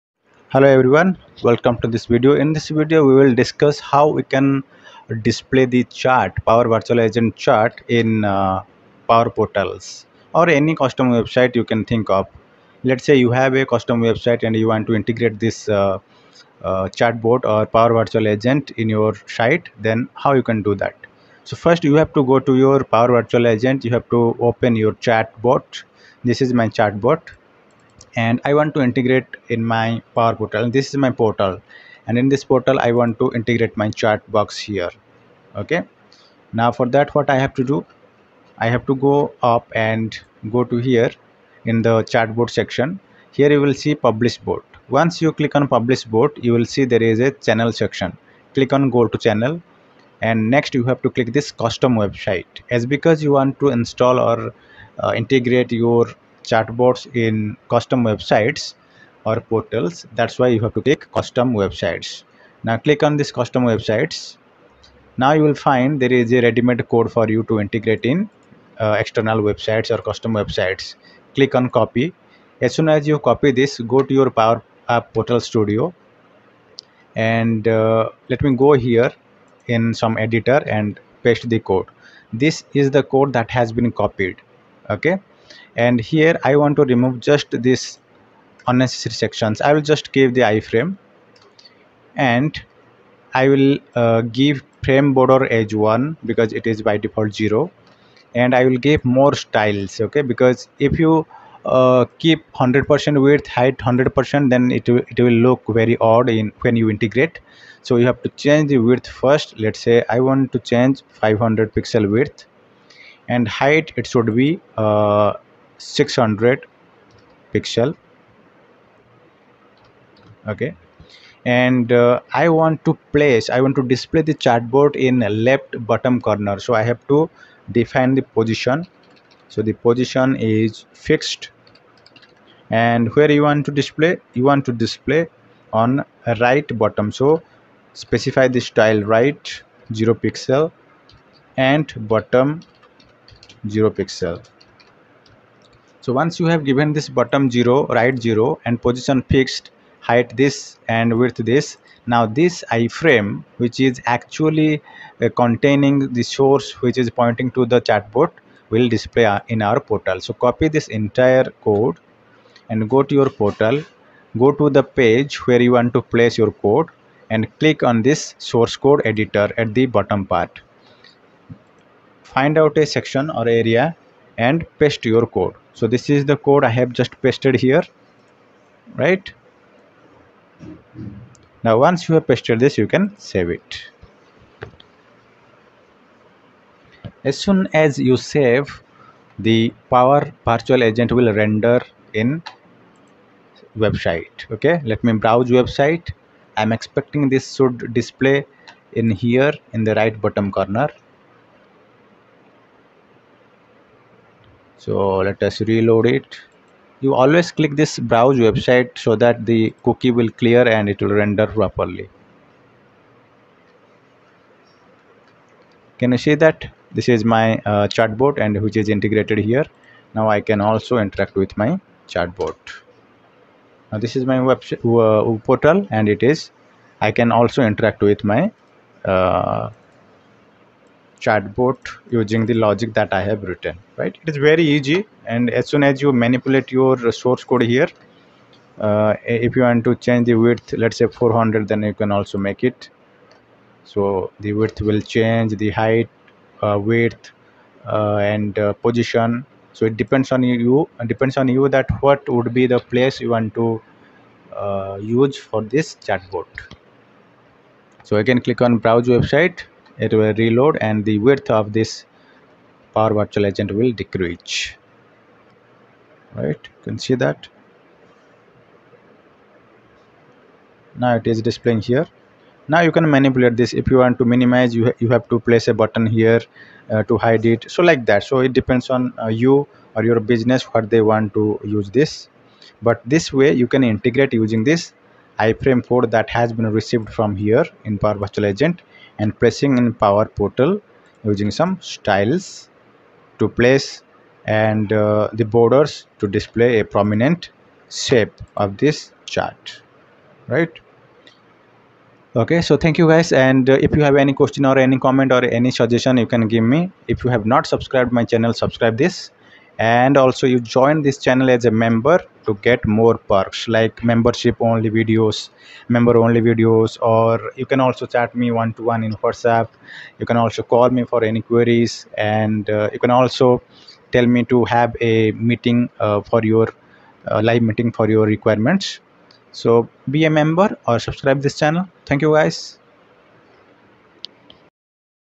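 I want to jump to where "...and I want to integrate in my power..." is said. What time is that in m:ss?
0:28.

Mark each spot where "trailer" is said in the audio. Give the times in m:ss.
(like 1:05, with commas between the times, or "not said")
not said.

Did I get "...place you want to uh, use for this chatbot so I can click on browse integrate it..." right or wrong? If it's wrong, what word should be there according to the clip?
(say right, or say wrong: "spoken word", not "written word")
wrong: "website", not "integrate".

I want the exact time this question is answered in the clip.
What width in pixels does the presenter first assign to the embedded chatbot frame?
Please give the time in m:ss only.
1:51.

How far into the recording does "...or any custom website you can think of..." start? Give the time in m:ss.
0:10.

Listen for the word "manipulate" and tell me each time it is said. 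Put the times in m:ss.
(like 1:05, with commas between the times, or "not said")
3:56, 4:33.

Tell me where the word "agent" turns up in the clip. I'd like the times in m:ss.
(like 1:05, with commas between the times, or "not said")
0:06, 0:18, 0:23, 3:10, 4:23, 4:48.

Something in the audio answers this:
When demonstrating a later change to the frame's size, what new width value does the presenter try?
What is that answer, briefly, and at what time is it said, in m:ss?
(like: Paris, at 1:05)
400, at 4:01.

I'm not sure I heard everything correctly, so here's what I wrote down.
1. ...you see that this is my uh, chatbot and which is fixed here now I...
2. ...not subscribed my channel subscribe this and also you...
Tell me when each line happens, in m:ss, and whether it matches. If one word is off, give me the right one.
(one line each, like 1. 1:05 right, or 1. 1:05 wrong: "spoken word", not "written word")
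1. 3:36 wrong: "integrated", not "fixed"
2. 5:07 right.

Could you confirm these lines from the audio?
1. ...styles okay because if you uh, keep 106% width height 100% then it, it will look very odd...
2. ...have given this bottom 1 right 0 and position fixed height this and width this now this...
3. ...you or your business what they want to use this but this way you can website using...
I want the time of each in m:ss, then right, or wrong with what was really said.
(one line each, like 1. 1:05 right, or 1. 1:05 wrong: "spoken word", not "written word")
1. 1:39 wrong: "100", not "106"
2. 2:26 wrong: "0", not "1"
3. 4:39 wrong: "integrate", not "website".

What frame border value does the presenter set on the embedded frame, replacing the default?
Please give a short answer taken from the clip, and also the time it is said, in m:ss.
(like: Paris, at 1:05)
1, at 1:34.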